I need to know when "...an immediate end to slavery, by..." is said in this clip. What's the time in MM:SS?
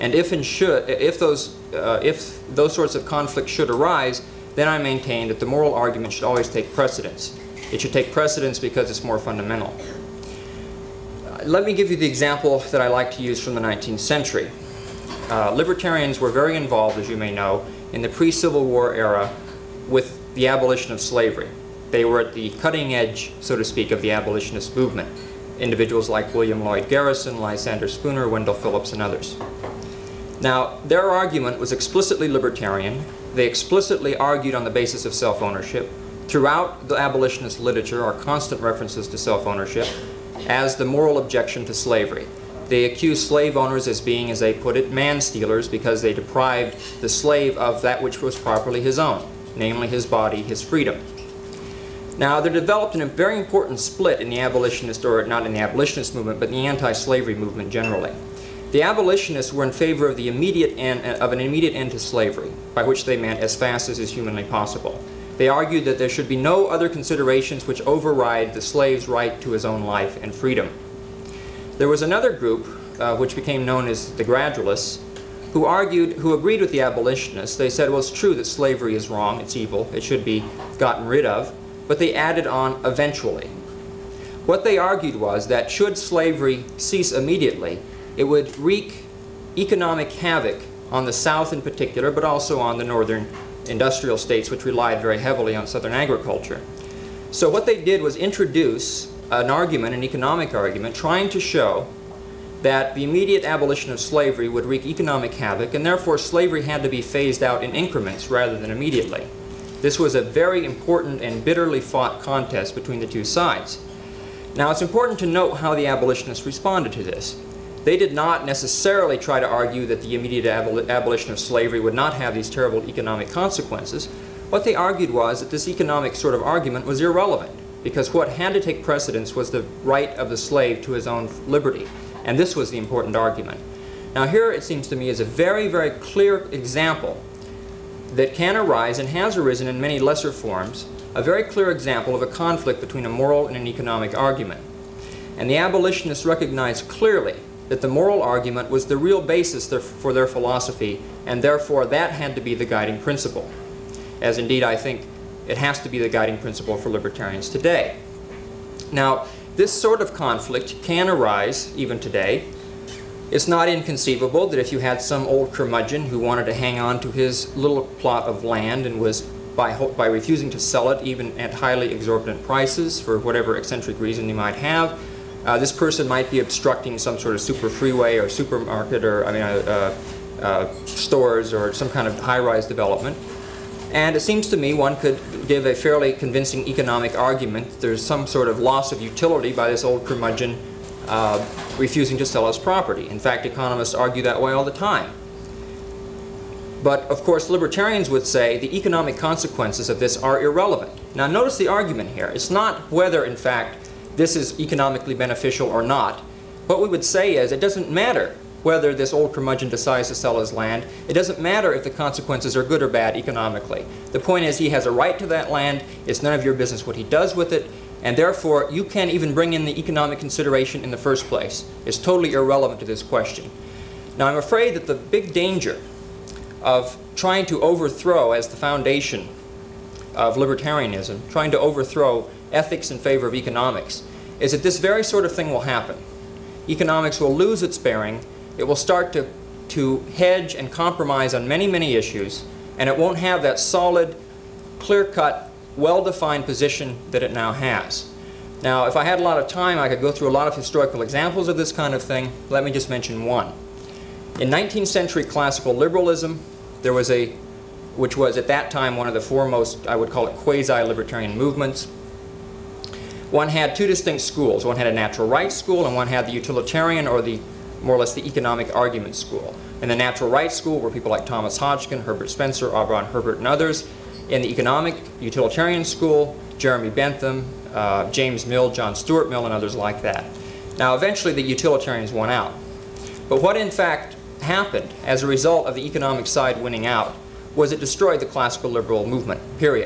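01:01.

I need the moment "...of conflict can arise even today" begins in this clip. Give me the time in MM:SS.
02:40.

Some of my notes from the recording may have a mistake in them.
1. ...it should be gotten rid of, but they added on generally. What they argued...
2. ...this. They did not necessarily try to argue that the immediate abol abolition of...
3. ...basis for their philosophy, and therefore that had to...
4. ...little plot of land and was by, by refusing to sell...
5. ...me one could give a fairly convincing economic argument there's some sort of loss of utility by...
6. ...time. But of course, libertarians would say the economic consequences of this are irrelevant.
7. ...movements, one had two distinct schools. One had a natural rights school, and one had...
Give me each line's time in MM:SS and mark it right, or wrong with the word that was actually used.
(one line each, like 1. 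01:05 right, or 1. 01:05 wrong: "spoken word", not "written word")
1. 01:19 wrong: "eventually", not "generally"
2. 01:57 right
3. 02:29 right
4. 02:47 right
5. 03:04 right
6. 03:14 right
7. 04:21 right.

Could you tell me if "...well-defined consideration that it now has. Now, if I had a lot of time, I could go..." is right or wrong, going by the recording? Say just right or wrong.
wrong.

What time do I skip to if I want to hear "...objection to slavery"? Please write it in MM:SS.
00:41.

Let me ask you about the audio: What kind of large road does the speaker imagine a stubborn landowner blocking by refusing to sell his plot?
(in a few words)
super freeway.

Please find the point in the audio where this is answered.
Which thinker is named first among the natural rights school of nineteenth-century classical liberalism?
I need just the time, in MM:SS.
04:31.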